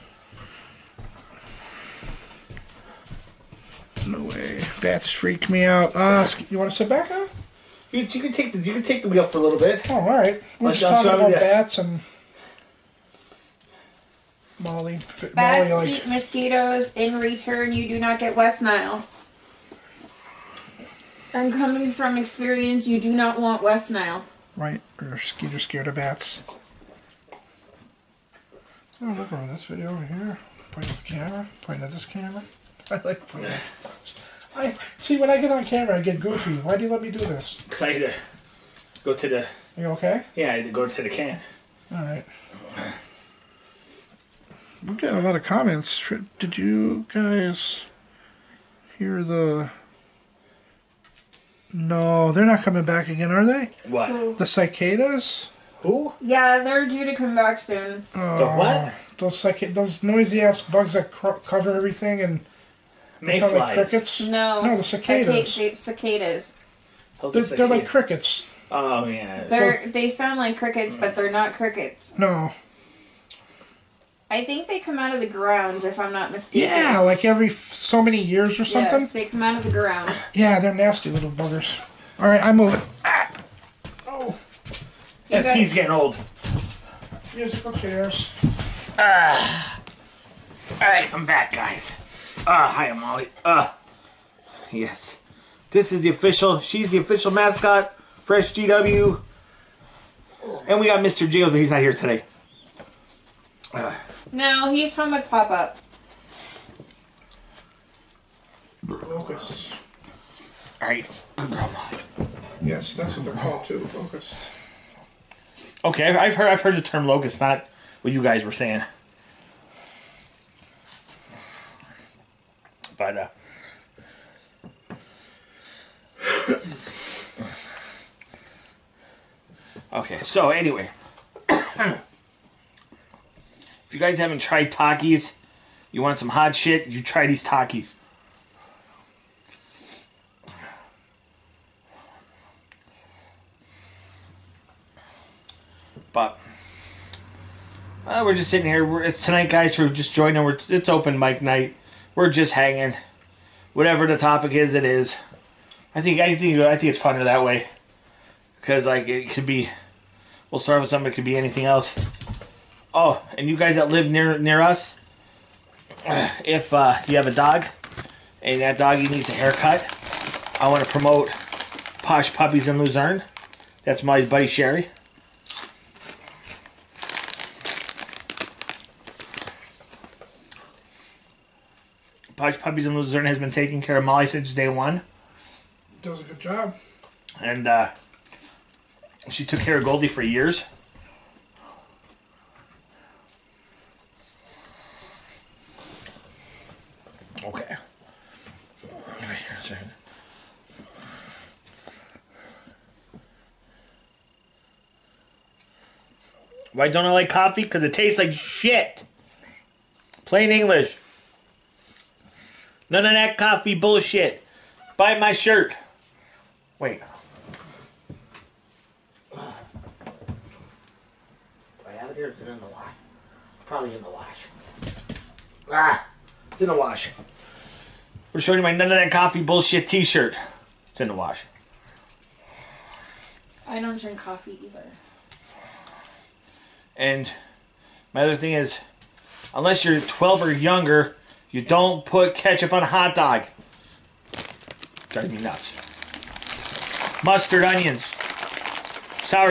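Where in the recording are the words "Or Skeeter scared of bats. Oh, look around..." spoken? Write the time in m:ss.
0:25.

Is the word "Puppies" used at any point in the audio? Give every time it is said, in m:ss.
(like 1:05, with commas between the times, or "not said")
2:52, 3:02.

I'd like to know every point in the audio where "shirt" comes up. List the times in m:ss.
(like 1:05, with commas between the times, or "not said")
3:35, 3:49.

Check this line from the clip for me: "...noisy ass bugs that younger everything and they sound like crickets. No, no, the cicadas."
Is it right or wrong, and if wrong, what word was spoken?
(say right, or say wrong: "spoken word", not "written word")
wrong: "cover", not "younger".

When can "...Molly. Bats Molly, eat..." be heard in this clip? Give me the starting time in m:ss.
0:14.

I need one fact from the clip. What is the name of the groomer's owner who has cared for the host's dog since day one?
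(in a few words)
Sherry.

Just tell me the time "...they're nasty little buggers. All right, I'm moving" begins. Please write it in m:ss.
1:20.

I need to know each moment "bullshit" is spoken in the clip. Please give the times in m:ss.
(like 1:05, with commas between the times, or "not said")
3:33, 3:49.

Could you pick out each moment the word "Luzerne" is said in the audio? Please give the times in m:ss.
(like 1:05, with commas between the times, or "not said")
2:52, 3:02.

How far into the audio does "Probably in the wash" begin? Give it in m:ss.
3:43.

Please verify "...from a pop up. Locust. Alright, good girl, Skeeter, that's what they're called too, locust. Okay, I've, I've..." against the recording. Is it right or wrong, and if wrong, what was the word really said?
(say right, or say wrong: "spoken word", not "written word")
wrong: "Yes", not "Skeeter".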